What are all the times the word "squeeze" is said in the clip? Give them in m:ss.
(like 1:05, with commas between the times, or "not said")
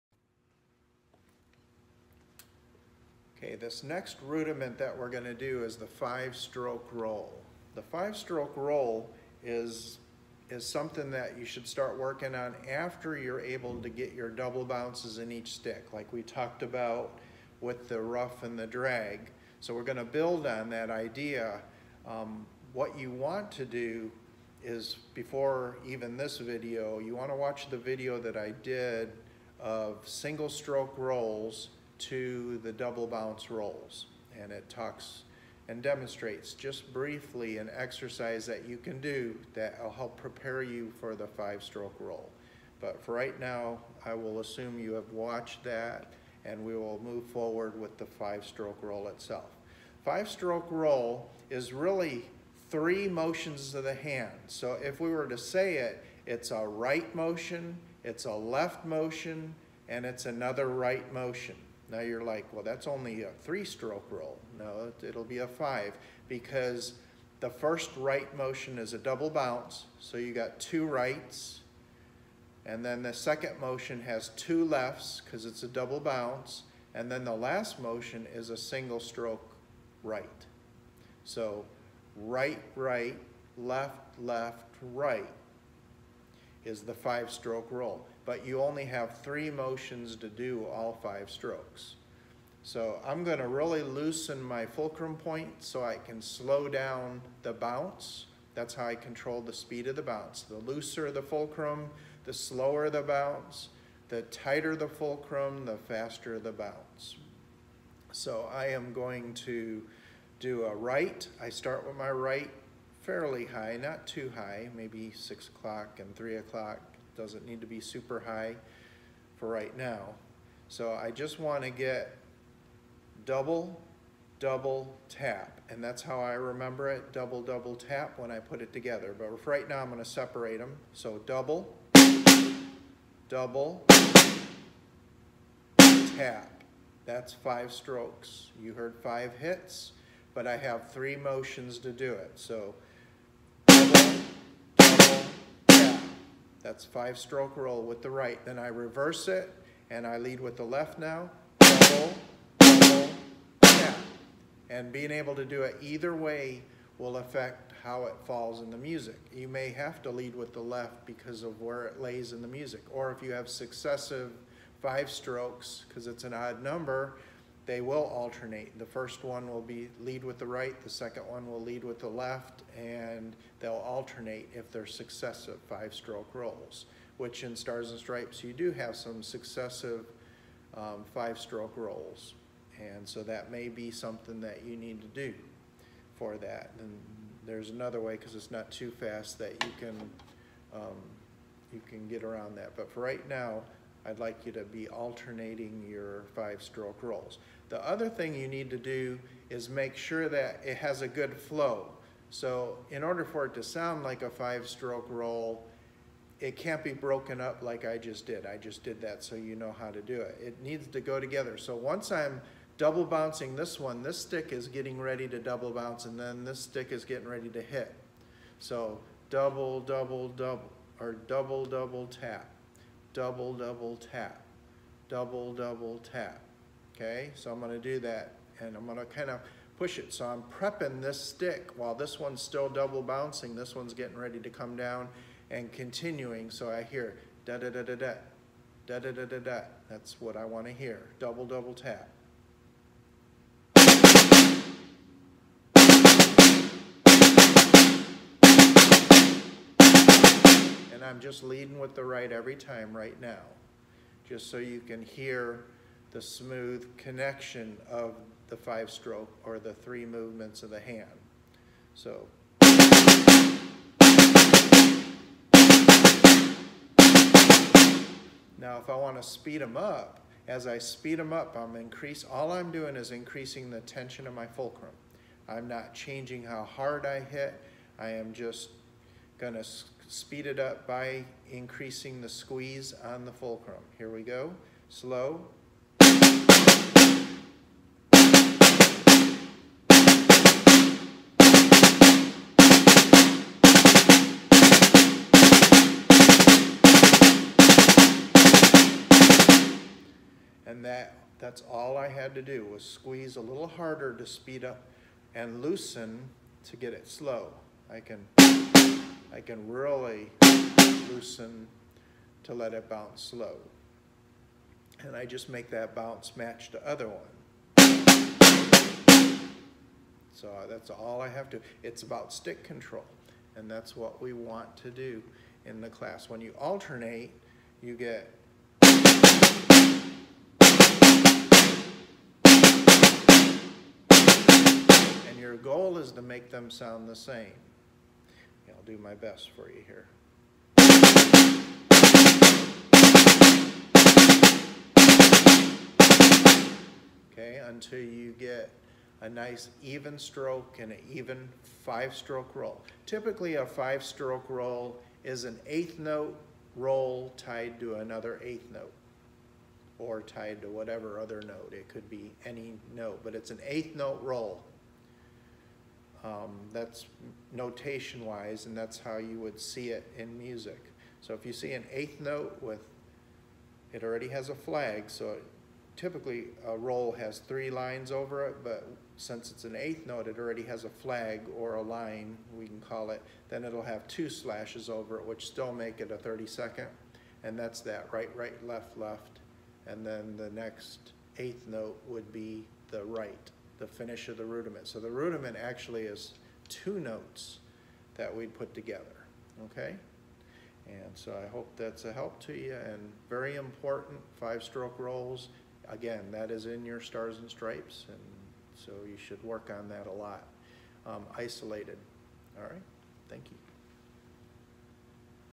4:42, 5:02.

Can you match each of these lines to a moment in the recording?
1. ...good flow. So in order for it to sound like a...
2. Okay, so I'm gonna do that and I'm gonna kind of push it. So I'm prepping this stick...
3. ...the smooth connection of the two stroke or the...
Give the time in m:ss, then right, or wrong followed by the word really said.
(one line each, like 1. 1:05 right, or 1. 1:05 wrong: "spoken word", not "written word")
1. 3:21 right
2. 3:46 right
3. 4:16 wrong: "five", not "two".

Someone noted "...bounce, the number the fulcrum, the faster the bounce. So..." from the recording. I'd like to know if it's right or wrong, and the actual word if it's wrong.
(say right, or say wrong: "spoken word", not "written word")
wrong: "tighter", not "number".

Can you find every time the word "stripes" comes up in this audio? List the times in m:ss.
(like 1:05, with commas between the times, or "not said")
2:57, 6:47.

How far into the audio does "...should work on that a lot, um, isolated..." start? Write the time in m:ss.
6:49.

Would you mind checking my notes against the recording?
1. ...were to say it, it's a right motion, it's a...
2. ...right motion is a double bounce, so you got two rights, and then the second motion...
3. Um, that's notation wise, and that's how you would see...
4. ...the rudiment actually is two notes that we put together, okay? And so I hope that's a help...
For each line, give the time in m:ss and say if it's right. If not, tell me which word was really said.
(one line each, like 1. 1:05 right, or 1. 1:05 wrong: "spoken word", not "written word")
1. 0:55 right
2. 1:07 right
3. 6:06 right
4. 6:35 right.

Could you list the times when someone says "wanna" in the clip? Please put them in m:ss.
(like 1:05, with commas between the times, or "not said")
0:27, 4:00.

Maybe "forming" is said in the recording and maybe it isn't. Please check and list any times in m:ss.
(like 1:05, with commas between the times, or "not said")
not said.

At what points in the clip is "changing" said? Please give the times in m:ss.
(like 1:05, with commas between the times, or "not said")
4:35.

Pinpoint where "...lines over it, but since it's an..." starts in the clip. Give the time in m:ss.
6:17.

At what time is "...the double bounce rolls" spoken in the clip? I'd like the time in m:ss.
0:32.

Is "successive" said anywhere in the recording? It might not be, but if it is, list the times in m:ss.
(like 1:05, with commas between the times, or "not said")
2:43, 2:54, 2:59.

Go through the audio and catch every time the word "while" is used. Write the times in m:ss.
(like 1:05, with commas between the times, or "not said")
3:51.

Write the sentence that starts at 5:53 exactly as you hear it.
Typically a five stroke roll is an eighth note roll tied to another eighth note or tied to whatever other note.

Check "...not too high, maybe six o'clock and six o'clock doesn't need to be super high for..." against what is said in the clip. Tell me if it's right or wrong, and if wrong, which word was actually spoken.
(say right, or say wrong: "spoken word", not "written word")
wrong: "three", not "six".